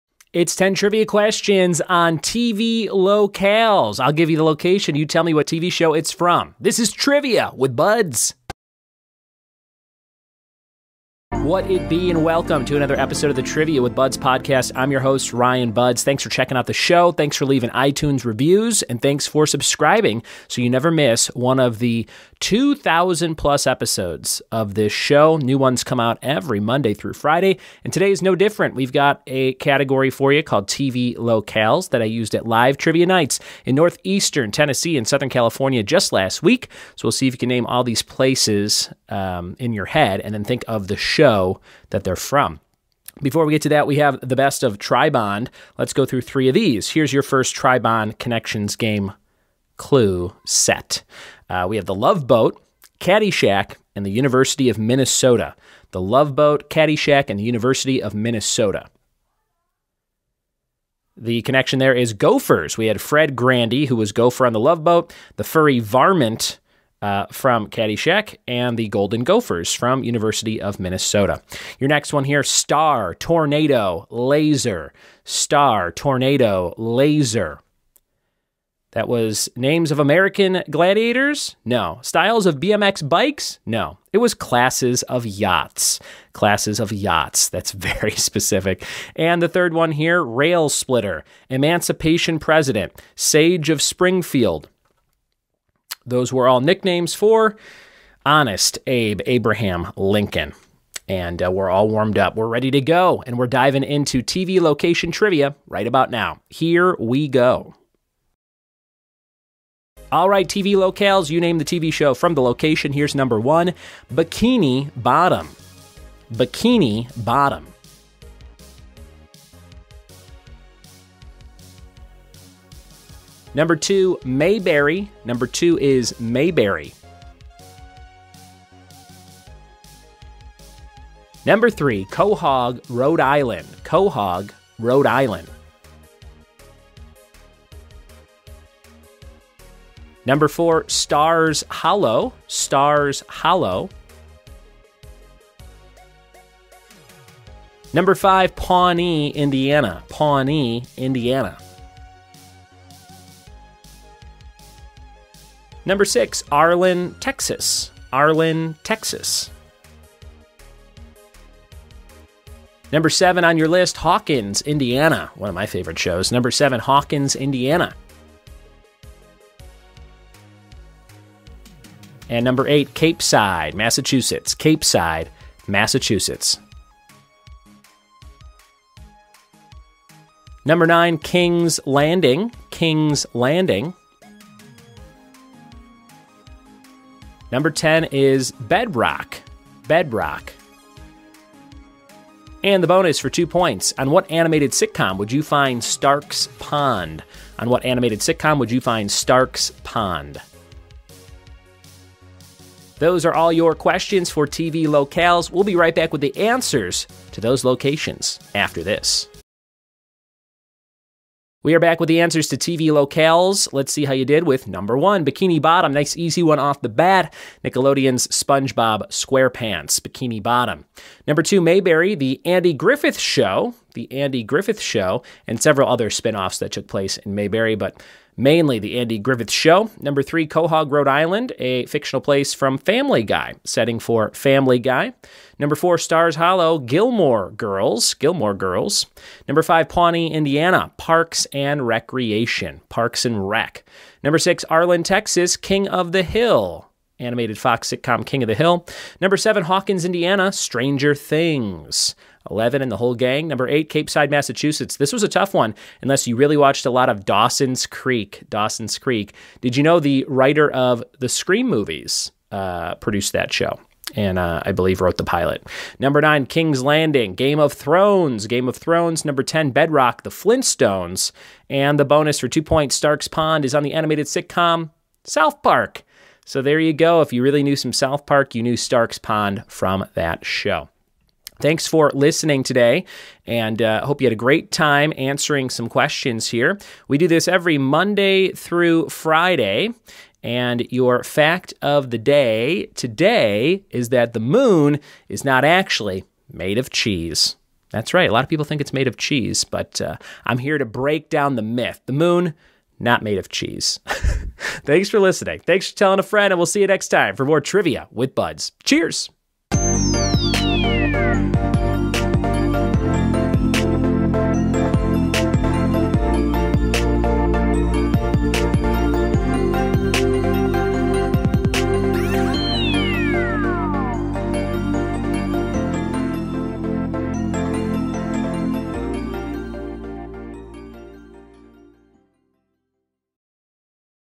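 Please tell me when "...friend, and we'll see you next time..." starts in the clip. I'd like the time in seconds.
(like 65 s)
306 s.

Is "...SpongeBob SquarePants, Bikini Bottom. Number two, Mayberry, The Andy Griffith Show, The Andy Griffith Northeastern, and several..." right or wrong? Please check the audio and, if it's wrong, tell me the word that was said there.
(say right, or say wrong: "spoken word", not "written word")
wrong: "Show", not "Northeastern".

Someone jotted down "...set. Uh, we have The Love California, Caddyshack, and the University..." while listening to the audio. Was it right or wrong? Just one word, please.
wrong.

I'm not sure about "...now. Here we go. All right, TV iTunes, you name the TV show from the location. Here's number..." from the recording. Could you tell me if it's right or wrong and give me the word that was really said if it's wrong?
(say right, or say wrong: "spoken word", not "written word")
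wrong: "locales", not "iTunes".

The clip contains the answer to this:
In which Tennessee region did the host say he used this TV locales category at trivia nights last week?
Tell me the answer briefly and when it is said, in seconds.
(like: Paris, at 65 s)
Northeastern Tennessee, at 33 s.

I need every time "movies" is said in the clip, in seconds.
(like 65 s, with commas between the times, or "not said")
261 s.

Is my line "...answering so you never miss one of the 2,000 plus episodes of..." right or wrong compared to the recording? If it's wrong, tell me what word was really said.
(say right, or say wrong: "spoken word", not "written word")
wrong: "subscribing", not "answering".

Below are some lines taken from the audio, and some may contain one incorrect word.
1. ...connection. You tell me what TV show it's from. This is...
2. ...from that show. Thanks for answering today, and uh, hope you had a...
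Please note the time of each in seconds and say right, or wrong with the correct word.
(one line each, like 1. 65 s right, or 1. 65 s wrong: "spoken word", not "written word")
1. 4 s wrong: "location", not "connection"
2. 279 s wrong: "listening", not "answering".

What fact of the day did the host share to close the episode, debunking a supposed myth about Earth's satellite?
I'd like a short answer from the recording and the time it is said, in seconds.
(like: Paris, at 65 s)
Moon not made of cheese, at 294 s.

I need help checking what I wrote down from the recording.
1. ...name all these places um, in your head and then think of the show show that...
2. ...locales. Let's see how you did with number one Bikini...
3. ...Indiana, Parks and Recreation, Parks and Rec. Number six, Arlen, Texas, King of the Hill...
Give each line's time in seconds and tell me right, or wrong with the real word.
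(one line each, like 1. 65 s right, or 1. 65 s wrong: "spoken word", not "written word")
1. 37 s right
2. 212 s right
3. 240 s right.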